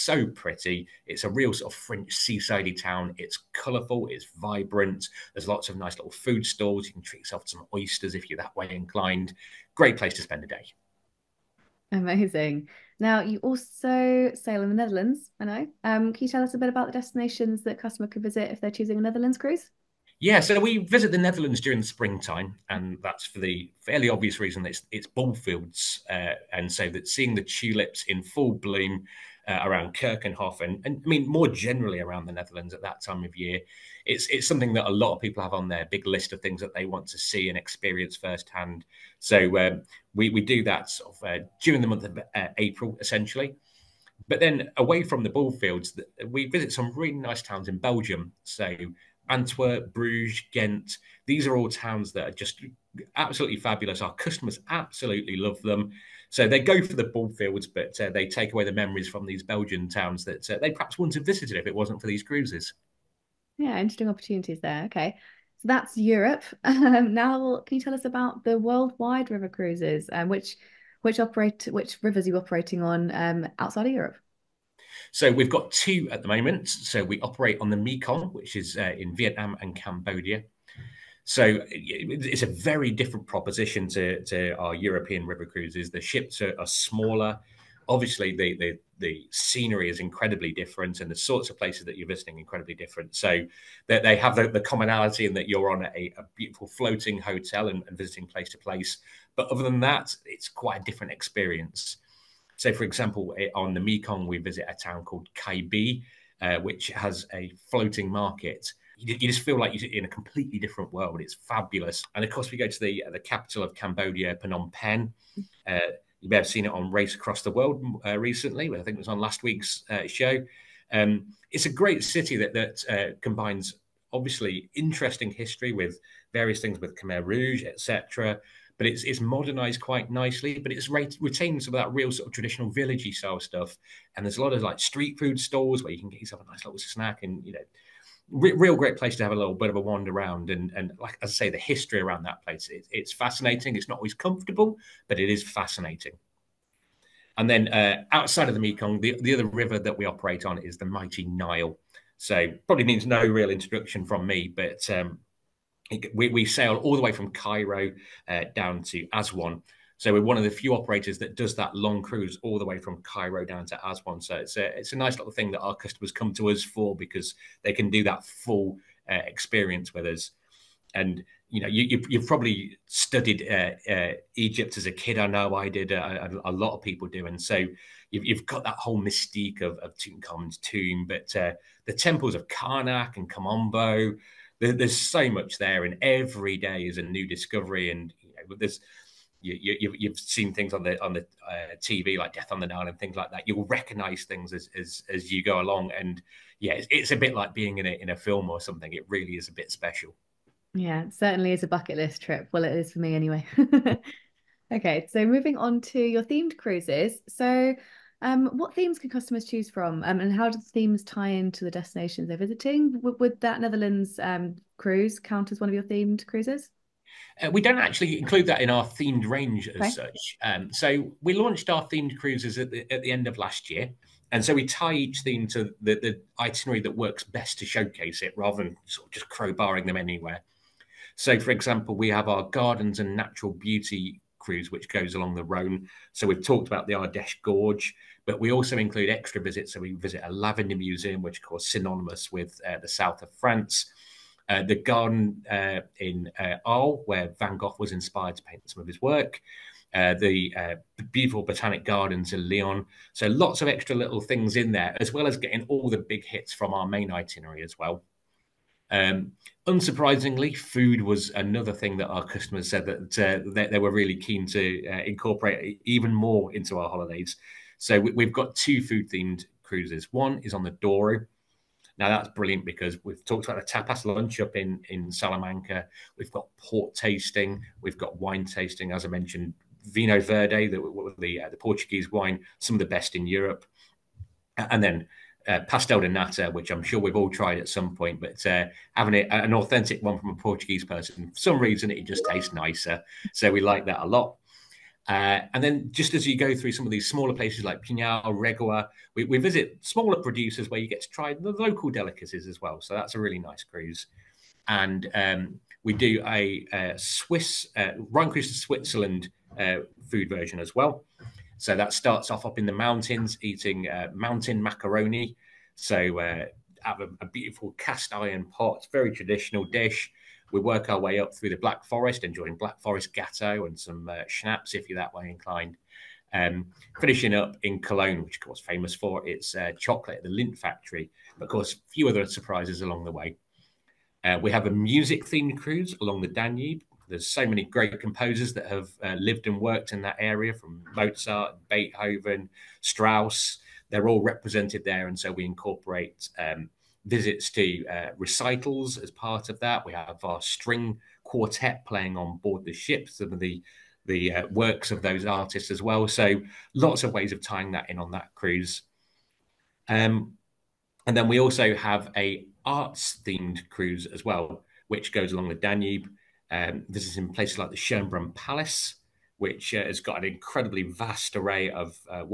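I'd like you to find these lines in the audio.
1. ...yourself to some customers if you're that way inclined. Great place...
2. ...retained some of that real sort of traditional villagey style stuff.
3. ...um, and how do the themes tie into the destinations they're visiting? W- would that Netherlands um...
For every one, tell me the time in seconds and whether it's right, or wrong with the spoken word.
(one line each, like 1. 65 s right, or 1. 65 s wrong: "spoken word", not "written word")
1. 7 s wrong: "oysters", not "customers"
2. 131 s right
3. 210 s right.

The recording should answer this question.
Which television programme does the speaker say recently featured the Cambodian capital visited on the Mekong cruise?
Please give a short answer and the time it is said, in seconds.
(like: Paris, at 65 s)
Race Across the World, at 116 s.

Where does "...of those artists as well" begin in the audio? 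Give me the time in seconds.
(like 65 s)
354 s.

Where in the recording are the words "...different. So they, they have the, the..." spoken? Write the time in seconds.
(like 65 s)
92 s.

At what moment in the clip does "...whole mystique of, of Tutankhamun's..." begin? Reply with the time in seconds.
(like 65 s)
178 s.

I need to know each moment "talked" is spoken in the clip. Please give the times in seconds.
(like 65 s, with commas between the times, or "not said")
236 s, 273 s.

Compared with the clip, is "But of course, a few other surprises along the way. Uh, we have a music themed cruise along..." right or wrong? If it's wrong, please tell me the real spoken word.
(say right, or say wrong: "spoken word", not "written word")
right.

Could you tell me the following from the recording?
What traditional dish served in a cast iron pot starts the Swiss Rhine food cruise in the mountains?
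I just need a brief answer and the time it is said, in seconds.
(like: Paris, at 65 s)
Mountain macaroni, at 314 s.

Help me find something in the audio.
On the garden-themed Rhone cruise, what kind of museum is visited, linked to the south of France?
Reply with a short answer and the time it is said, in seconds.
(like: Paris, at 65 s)
Lavender museum, at 240 s.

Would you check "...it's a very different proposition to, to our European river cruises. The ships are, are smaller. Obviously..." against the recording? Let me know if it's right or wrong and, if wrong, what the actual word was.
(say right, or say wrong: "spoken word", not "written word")
right.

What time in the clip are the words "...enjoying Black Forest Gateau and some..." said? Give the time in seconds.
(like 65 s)
322 s.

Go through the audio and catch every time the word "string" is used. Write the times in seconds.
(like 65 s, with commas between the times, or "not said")
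350 s.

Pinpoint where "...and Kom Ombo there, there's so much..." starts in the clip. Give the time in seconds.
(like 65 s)
183 s.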